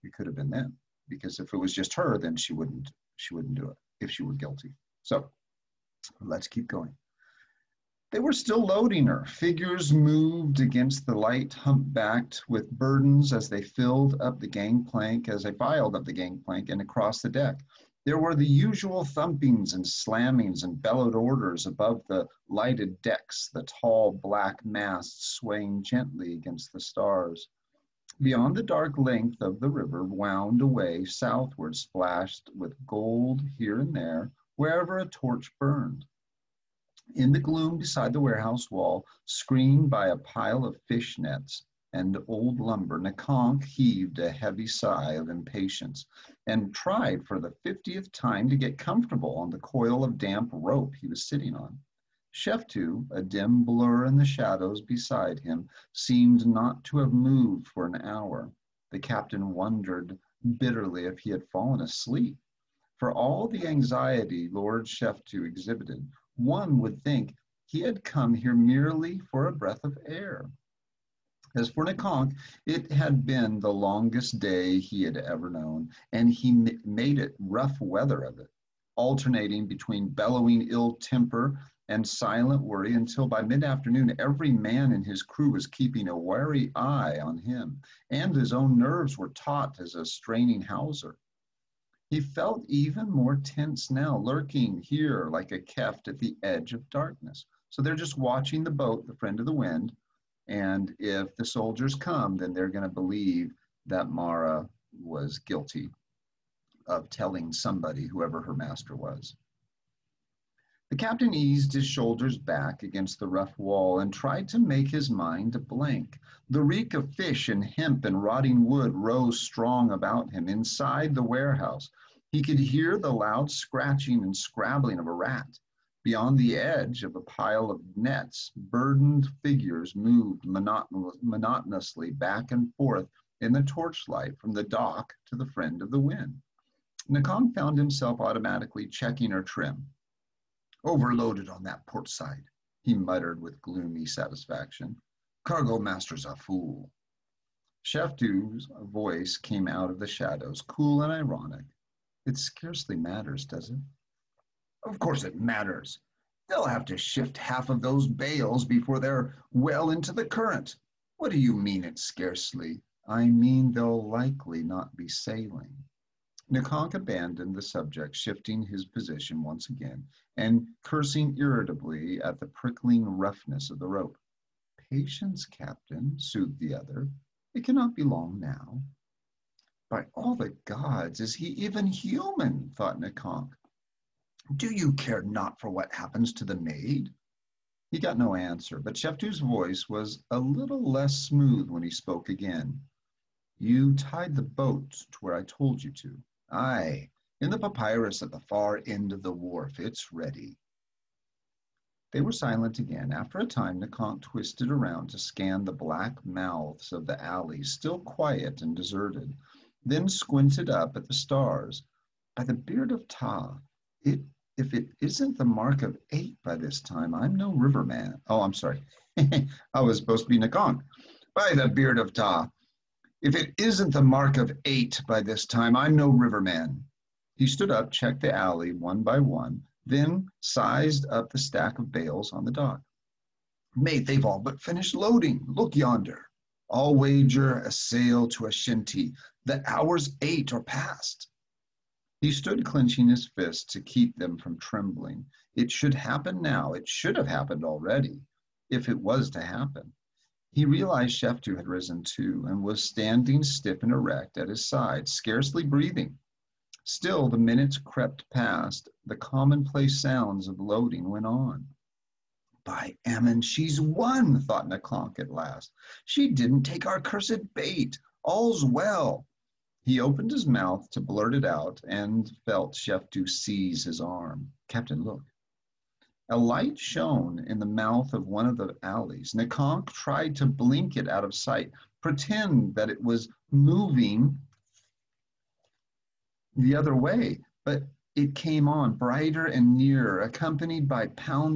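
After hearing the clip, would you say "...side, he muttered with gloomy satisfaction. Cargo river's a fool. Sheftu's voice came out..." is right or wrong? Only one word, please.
wrong.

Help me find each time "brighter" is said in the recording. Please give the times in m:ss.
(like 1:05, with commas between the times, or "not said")
4:48.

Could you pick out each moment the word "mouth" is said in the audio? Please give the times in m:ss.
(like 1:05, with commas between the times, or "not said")
3:26, 4:30, 4:37.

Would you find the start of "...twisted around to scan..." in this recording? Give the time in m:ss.
3:24.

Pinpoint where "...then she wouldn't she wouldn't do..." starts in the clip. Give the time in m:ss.
0:02.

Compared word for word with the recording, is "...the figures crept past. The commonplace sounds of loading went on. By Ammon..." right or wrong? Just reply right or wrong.
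wrong.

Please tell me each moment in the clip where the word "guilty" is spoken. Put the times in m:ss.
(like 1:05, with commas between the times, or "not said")
0:04, 1:45.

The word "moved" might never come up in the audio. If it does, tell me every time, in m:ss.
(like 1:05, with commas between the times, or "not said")
0:09, 0:57, 2:09.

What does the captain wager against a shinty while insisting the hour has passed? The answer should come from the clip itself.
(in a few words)
A sail.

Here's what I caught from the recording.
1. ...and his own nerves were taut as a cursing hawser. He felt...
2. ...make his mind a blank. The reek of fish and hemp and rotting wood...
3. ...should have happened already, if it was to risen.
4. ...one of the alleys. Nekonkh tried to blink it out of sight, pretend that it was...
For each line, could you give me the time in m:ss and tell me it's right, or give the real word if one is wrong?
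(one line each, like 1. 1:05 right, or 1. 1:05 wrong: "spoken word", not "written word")
1. 1:28 wrong: "straining", not "cursing"
2. 1:54 right
3. 4:06 wrong: "happen", not "risen"
4. 4:38 right.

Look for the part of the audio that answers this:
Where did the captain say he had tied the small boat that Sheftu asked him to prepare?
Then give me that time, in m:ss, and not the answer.
3:17.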